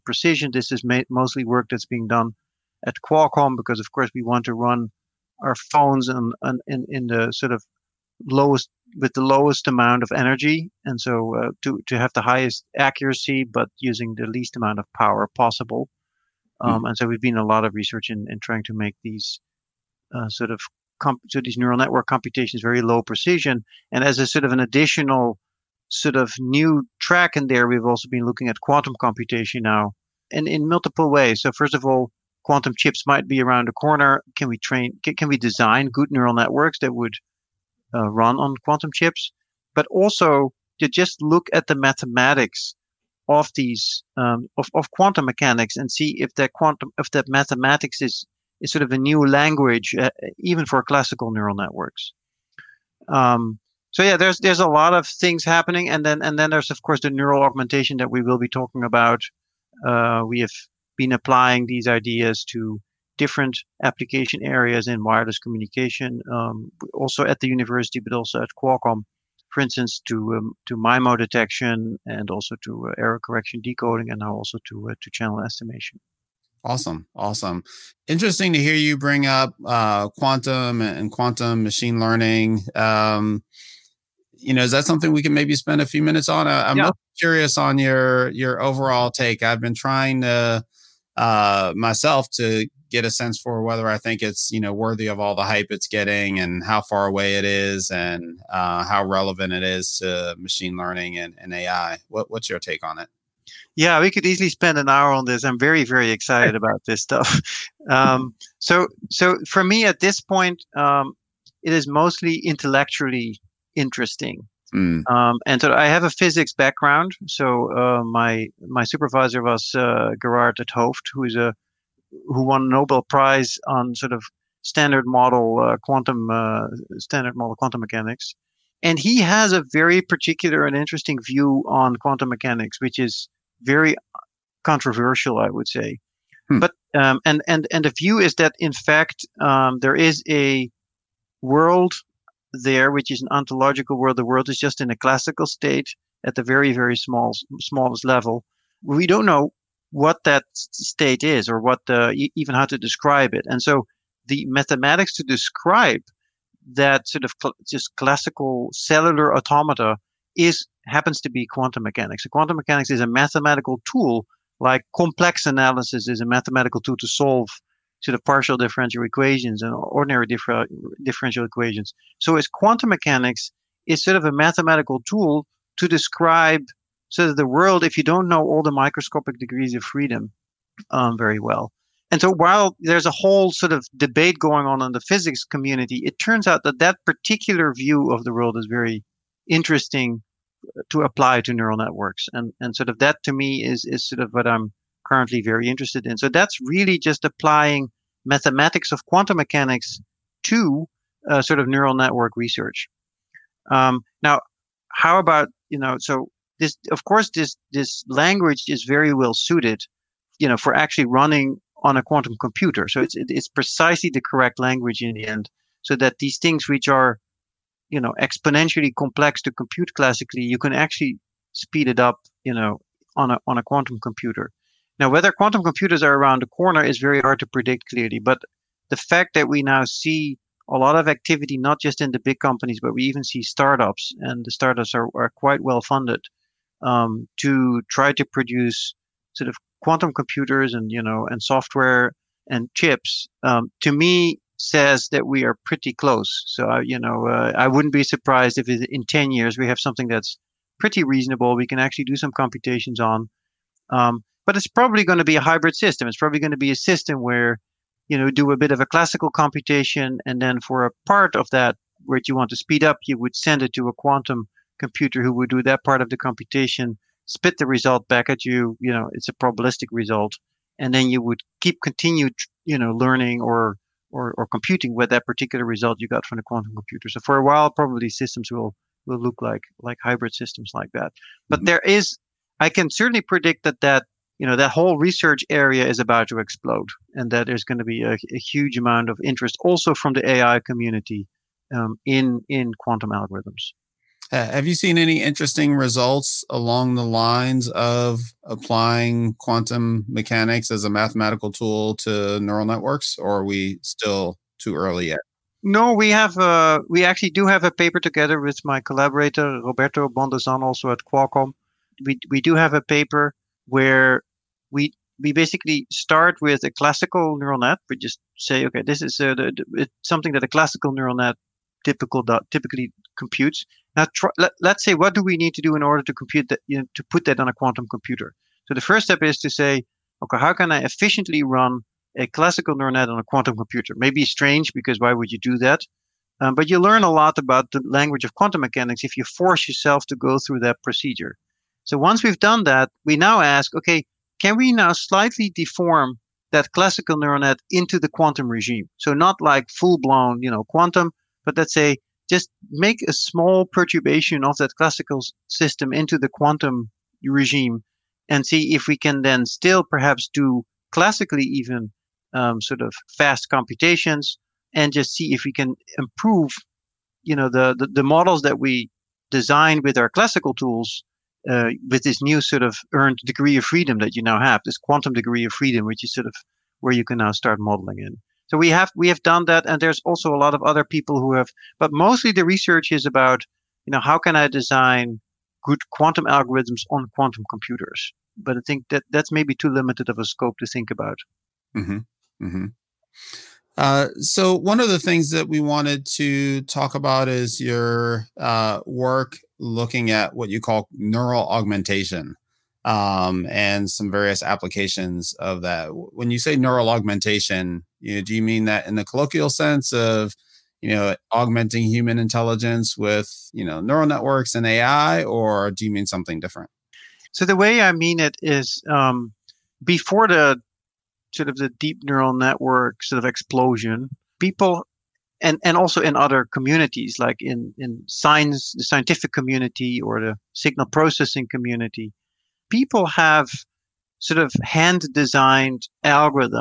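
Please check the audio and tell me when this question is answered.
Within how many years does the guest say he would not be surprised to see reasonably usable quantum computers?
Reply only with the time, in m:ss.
4:09.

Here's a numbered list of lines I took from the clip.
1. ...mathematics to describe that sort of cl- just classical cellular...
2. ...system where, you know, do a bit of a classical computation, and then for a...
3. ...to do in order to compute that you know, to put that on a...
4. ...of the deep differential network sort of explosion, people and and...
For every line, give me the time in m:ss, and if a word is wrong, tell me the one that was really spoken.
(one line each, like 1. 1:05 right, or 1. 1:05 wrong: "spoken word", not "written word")
1. 2:34 right
2. 4:16 right
3. 5:25 right
4. 7:01 wrong: "neural", not "differential".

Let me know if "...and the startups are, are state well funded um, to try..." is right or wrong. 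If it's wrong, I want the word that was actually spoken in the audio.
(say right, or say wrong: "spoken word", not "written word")
wrong: "quite", not "state".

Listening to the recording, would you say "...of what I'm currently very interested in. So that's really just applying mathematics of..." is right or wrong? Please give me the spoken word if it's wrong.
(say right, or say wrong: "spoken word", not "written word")
right.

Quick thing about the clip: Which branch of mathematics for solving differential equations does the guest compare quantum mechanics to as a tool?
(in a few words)
Complex analysis.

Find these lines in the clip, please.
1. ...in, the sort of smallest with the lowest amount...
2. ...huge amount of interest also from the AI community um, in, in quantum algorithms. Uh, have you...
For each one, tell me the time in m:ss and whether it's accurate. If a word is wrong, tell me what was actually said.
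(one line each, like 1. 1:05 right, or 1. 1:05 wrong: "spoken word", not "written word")
1. 0:06 wrong: "lowest", not "smallest"
2. 4:48 right.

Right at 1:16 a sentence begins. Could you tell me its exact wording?
Awesome, awesome, interesting to hear you bring up uh, quantum and quantum machine learning.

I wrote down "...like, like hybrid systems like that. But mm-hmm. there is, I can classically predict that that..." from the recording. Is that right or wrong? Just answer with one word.
wrong.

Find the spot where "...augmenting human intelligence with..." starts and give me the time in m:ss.
6:51.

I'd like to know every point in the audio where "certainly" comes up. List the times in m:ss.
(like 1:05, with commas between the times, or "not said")
4:42.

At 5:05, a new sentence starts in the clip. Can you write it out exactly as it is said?
No, we have uh, we actually do have a paper together with my collaborator Roberto Bondesan, also at Qualcomm.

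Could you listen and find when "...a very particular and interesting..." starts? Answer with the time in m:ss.
2:09.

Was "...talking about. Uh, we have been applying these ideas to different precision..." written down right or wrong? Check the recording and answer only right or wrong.
wrong.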